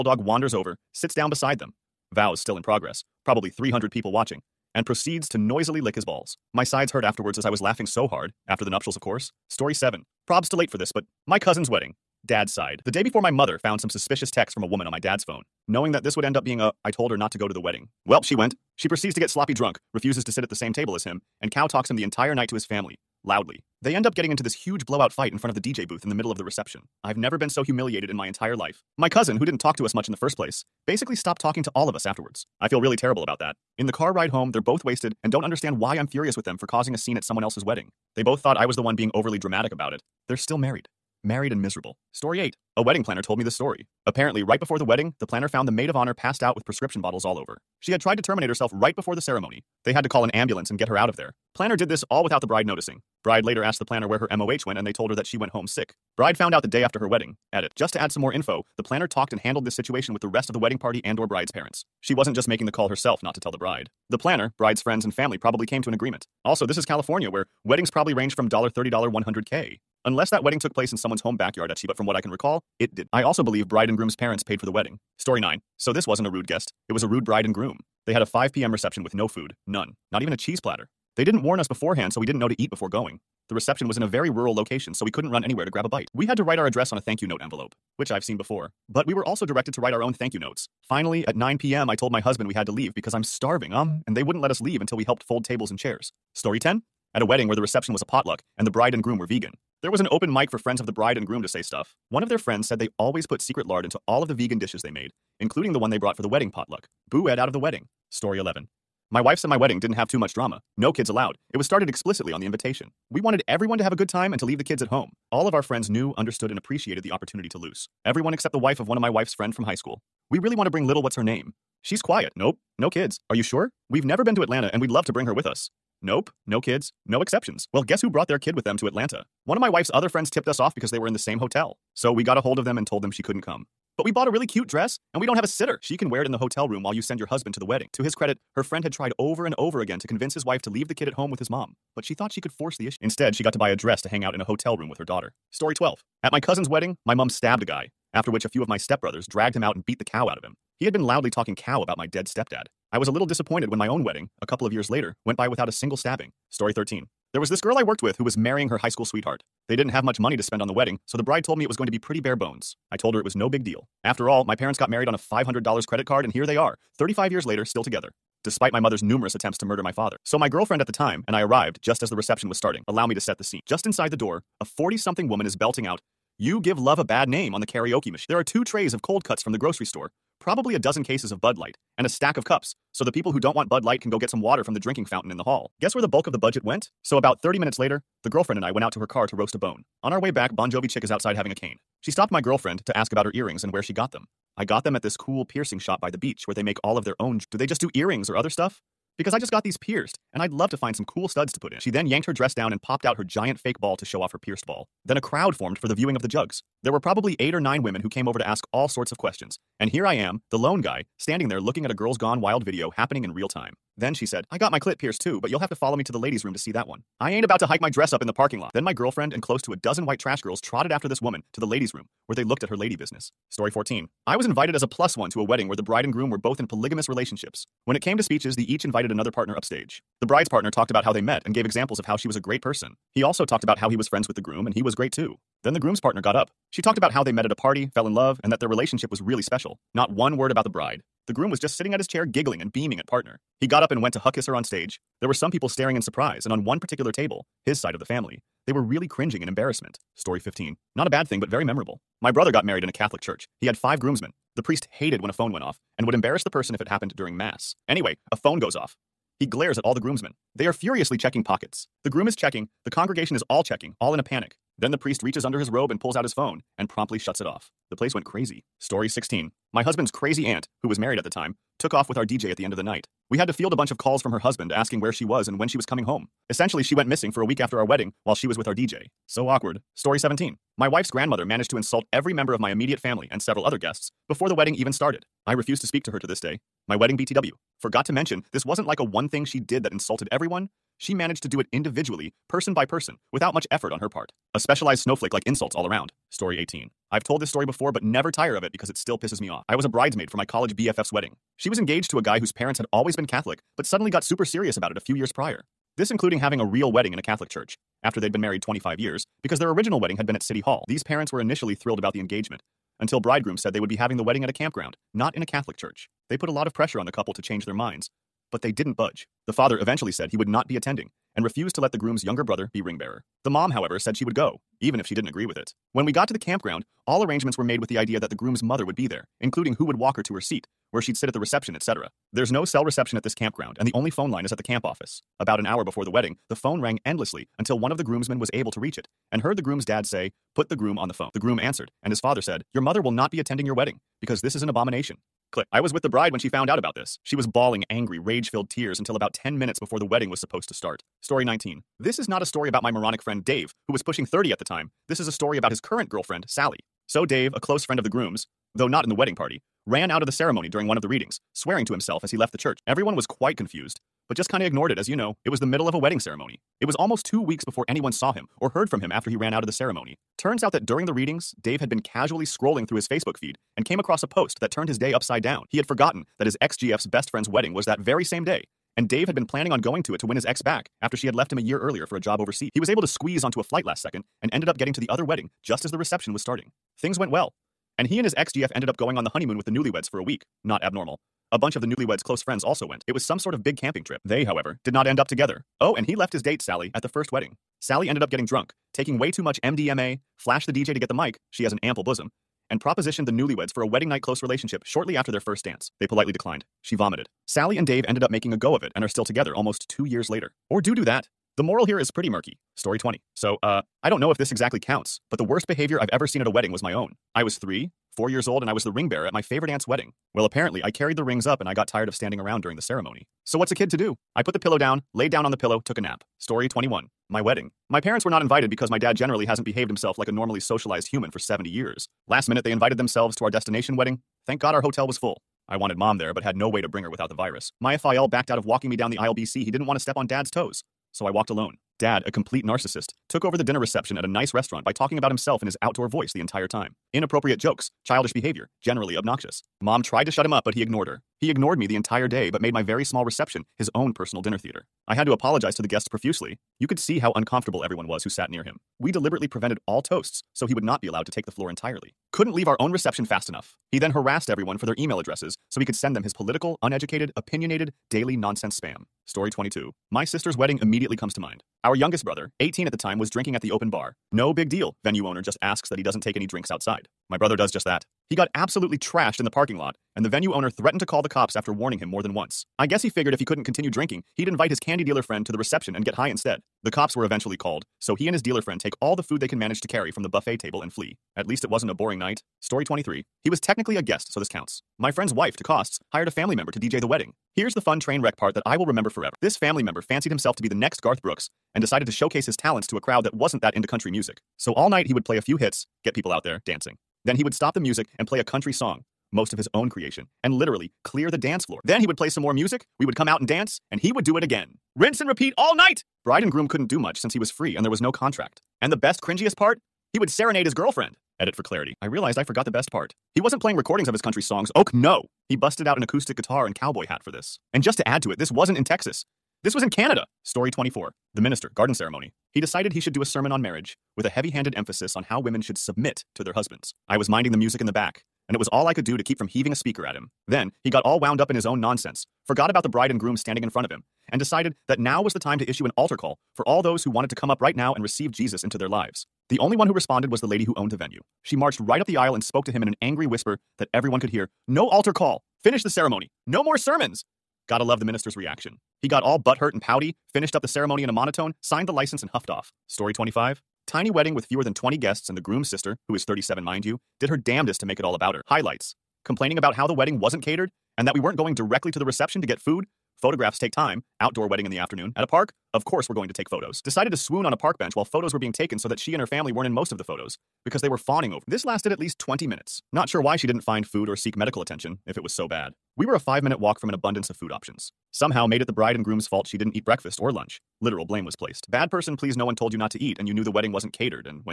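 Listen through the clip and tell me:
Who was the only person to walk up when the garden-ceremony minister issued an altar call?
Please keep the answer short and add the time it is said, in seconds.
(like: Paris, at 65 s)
the venue owner, at 550 s.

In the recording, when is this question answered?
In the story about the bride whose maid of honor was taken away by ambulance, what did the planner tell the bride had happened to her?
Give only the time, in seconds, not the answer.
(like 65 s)
55 s.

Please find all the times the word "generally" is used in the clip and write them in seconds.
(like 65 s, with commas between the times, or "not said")
429 s, 448 s.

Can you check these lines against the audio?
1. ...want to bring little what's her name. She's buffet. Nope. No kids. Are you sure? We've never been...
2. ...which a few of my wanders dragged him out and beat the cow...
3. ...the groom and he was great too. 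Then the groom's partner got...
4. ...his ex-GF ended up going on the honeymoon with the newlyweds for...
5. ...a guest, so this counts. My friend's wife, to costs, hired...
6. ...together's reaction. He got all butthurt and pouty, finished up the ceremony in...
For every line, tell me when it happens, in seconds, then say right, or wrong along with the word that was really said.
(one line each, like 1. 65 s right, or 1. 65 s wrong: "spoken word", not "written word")
1. 120 s wrong: "quiet", not "buffet"
2. 148 s wrong: "stepbrothers", not "wanders"
3. 234 s right
4. 388 s right
5. 493 s right
6. 558 s wrong: "minister", not "together".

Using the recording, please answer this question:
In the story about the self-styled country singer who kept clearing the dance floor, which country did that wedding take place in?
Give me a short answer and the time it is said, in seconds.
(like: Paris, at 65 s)
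Canada, at 529 s.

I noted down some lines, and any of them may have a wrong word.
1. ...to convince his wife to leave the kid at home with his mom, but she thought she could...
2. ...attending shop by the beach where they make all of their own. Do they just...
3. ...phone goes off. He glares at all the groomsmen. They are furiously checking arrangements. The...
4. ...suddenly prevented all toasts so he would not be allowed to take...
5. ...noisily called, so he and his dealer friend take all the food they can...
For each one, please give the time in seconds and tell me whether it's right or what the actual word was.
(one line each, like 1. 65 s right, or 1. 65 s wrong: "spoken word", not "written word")
1. 139 s right
2. 195 s wrong: "piercing", not "attending"
3. 258 s wrong: "pockets", not "arrangements"
4. 459 s wrong: "deliberately", not "suddenly"
5. 487 s wrong: "eventually", not "noisily".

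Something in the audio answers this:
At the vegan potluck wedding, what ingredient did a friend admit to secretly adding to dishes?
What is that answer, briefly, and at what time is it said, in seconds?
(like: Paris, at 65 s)
lard, at 103 s.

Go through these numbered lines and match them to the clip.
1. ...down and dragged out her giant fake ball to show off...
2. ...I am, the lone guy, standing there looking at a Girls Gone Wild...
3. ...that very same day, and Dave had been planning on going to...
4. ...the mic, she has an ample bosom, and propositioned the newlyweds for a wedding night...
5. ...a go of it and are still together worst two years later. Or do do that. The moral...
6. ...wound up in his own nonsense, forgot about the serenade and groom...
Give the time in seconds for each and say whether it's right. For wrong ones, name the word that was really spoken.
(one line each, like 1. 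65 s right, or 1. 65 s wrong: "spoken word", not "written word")
1. 202 s wrong: "popped", not "dragged"
2. 210 s right
3. 377 s right
4. 401 s right
5. 408 s wrong: "almost", not "worst"
6. 541 s wrong: "bride", not "serenade".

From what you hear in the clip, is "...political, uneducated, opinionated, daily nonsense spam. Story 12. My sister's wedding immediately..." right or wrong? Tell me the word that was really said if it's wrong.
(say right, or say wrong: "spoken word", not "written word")
wrong: "22", not "12".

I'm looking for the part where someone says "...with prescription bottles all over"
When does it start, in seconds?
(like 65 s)
46 s.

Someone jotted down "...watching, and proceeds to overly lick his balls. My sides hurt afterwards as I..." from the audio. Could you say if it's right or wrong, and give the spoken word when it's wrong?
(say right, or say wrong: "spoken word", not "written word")
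wrong: "noisily", not "overly".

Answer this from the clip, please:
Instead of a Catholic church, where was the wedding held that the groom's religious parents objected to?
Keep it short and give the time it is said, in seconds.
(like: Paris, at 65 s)
a campground, at 314 s.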